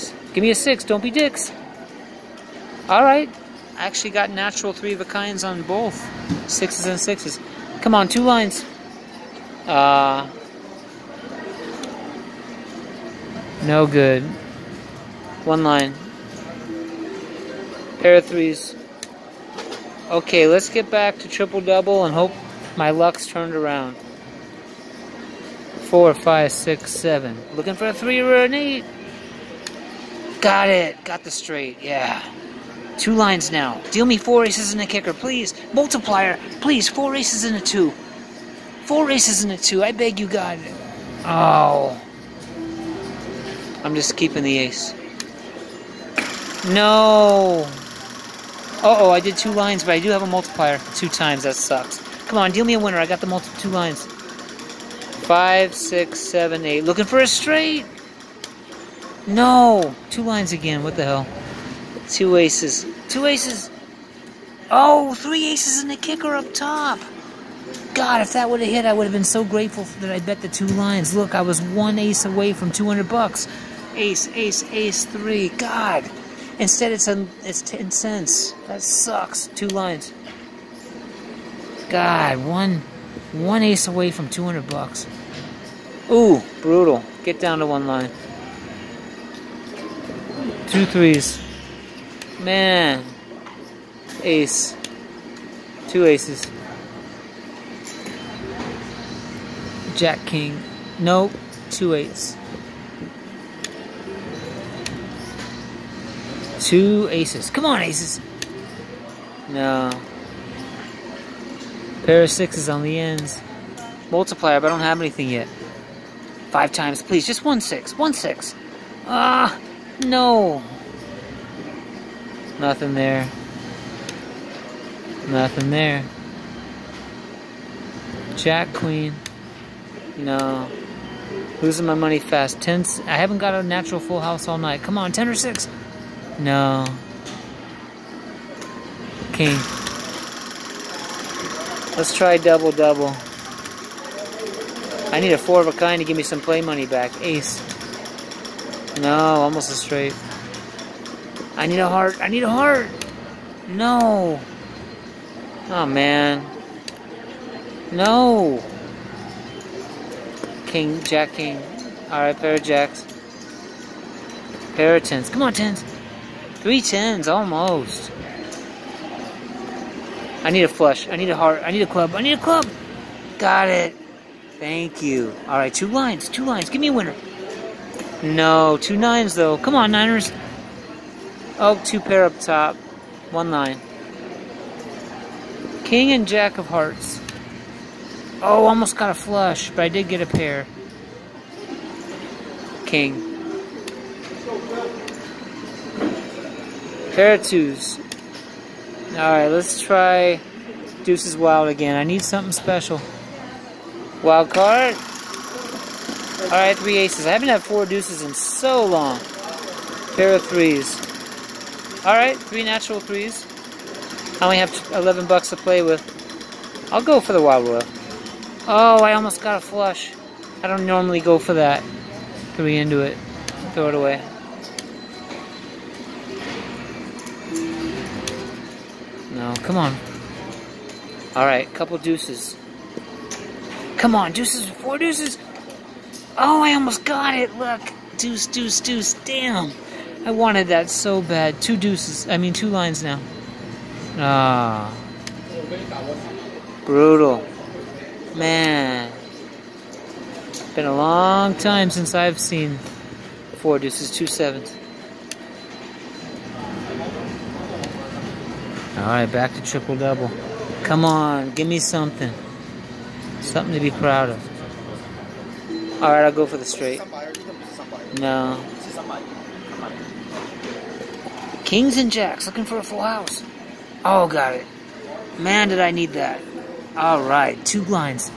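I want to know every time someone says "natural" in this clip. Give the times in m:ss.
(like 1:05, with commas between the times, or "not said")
0:04, 2:13, 3:32.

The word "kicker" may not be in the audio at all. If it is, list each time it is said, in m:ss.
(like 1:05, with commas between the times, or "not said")
0:34, 1:05.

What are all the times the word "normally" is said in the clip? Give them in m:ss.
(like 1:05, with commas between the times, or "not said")
3:40.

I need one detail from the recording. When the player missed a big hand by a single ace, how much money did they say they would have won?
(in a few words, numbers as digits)
$200.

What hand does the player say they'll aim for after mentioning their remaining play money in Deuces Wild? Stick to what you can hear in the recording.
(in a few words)
Wild Royal.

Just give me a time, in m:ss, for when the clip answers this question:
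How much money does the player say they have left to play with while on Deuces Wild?
3:34.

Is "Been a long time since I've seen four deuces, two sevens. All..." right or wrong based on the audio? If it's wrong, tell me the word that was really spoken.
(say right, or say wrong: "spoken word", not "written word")
right.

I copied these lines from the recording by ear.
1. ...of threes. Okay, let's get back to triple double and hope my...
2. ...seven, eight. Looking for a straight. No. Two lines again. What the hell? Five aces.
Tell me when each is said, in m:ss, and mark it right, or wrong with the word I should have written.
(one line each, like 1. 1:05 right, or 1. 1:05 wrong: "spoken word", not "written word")
1. 0:18 right
2. 0:56 wrong: "Two", not "Five".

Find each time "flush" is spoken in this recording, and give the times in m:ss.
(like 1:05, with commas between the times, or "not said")
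2:50, 3:09, 3:39.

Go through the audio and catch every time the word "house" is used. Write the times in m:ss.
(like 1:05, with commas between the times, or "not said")
2:14, 4:33.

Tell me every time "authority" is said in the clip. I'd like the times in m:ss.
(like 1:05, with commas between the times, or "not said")
not said.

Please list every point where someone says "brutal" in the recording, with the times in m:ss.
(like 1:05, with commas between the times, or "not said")
1:26, 4:06.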